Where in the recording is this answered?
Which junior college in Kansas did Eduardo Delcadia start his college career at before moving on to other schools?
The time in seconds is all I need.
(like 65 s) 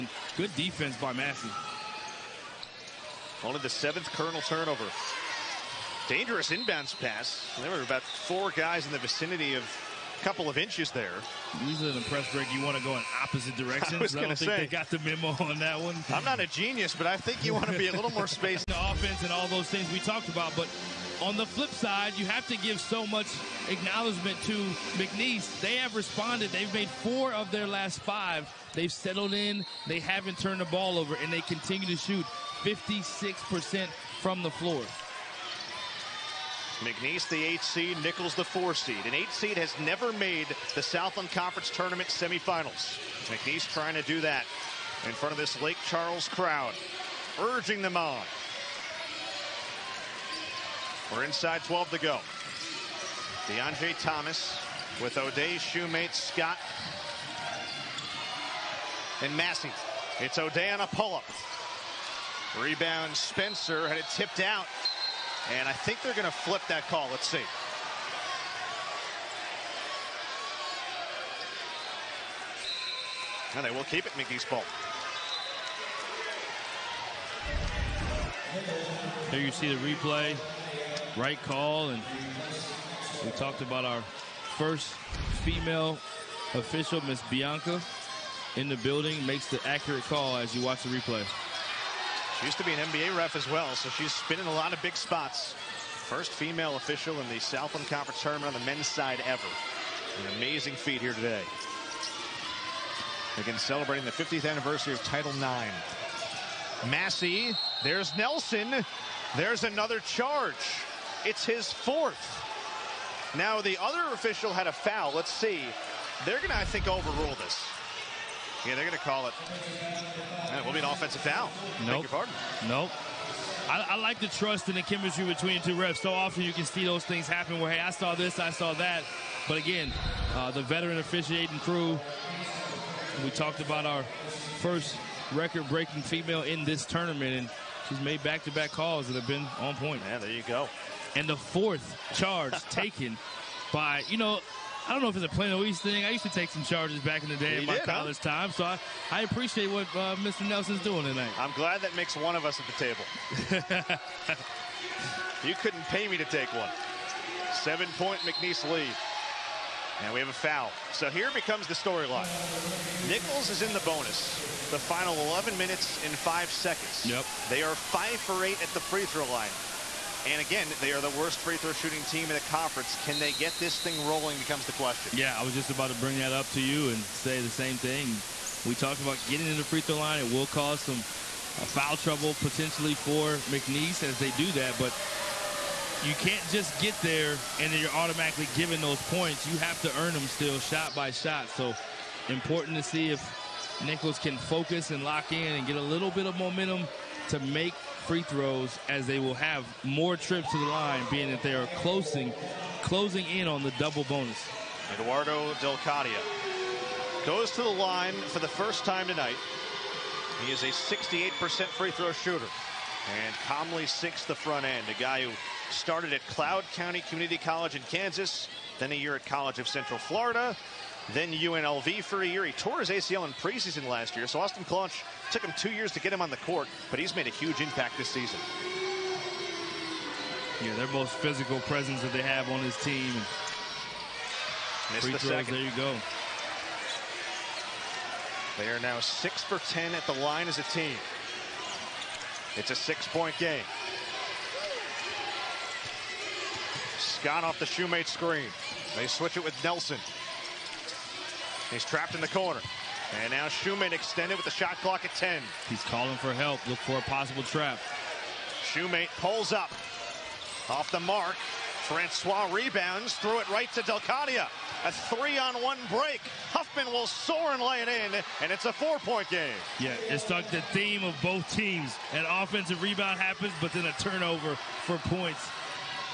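216 s.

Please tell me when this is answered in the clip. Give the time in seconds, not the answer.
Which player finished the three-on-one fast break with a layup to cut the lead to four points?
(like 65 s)
266 s.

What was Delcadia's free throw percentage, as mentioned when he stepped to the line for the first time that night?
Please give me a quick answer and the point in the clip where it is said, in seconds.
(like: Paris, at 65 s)
68%, at 210 s.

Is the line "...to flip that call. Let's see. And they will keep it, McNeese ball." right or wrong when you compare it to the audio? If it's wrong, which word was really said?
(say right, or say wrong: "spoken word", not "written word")
right.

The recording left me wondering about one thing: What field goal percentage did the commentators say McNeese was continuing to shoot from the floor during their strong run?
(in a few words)
56%.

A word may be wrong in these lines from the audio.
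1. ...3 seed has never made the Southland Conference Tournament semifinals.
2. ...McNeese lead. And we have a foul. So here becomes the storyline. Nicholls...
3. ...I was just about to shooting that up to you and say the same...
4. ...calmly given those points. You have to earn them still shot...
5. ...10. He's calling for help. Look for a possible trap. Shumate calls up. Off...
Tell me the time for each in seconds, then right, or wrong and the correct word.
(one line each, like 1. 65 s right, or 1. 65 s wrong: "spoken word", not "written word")
1. 39 s wrong: "8", not "3"
2. 158 s right
3. 175 s wrong: "bring", not "shooting"
4. 187 s wrong: "automatically", not "calmly"
5. 255 s wrong: "pulls", not "calls".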